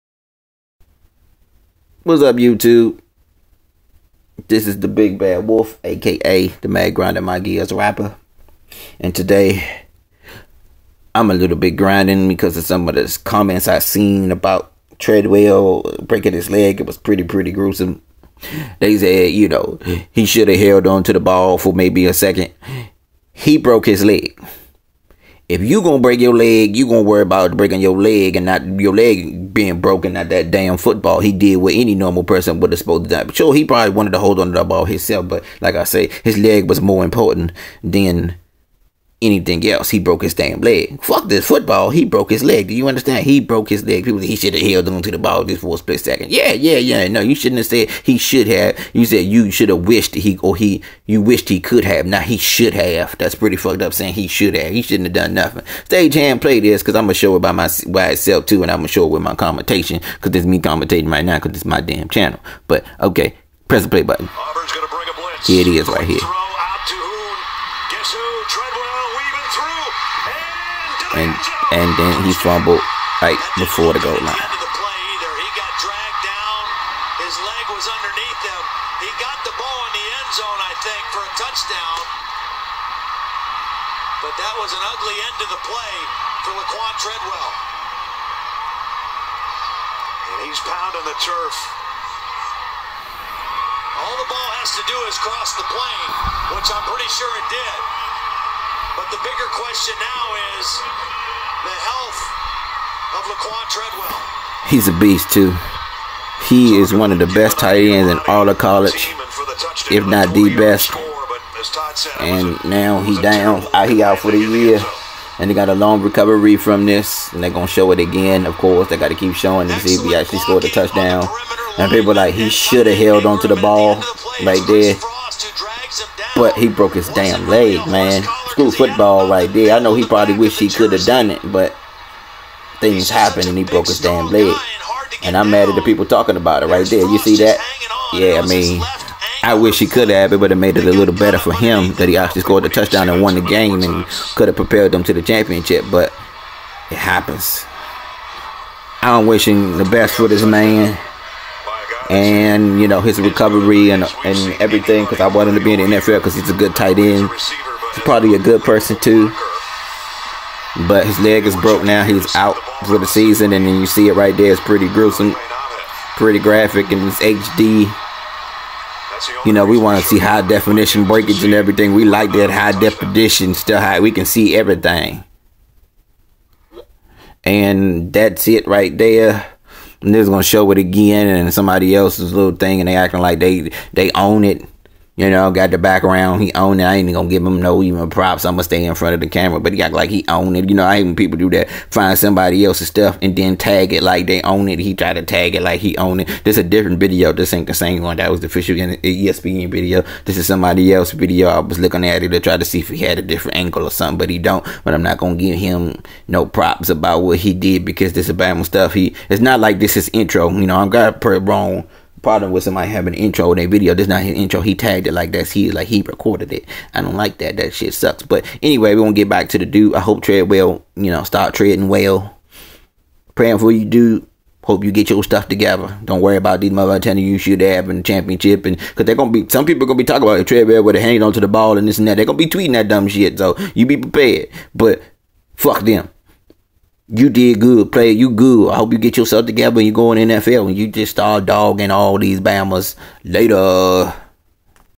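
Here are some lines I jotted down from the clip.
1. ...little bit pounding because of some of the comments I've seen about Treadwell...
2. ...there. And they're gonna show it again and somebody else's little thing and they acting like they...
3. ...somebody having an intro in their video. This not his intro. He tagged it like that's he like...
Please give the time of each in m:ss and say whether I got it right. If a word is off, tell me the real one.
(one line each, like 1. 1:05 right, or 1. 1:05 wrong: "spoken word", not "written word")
1. 0:11 wrong: "grinding", not "pounding"
2. 2:58 right
3. 3:32 right.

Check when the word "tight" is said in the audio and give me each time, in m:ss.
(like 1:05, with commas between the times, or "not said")
1:47, 2:36.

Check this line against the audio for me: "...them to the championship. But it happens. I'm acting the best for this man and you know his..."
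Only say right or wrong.
wrong.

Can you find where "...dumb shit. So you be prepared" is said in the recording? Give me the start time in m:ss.
3:52.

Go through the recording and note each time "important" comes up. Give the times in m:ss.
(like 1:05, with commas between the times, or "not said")
0:37.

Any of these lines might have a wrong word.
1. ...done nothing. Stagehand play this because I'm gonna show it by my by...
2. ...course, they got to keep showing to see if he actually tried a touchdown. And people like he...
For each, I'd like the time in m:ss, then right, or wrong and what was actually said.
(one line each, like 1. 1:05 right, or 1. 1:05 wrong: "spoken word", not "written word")
1. 0:55 right
2. 1:58 wrong: "scored", not "tried".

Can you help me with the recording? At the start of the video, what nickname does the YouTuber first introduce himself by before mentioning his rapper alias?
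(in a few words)
the Big Bad Wolf.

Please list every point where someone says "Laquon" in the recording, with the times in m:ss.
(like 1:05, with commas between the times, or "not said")
1:26, 1:43.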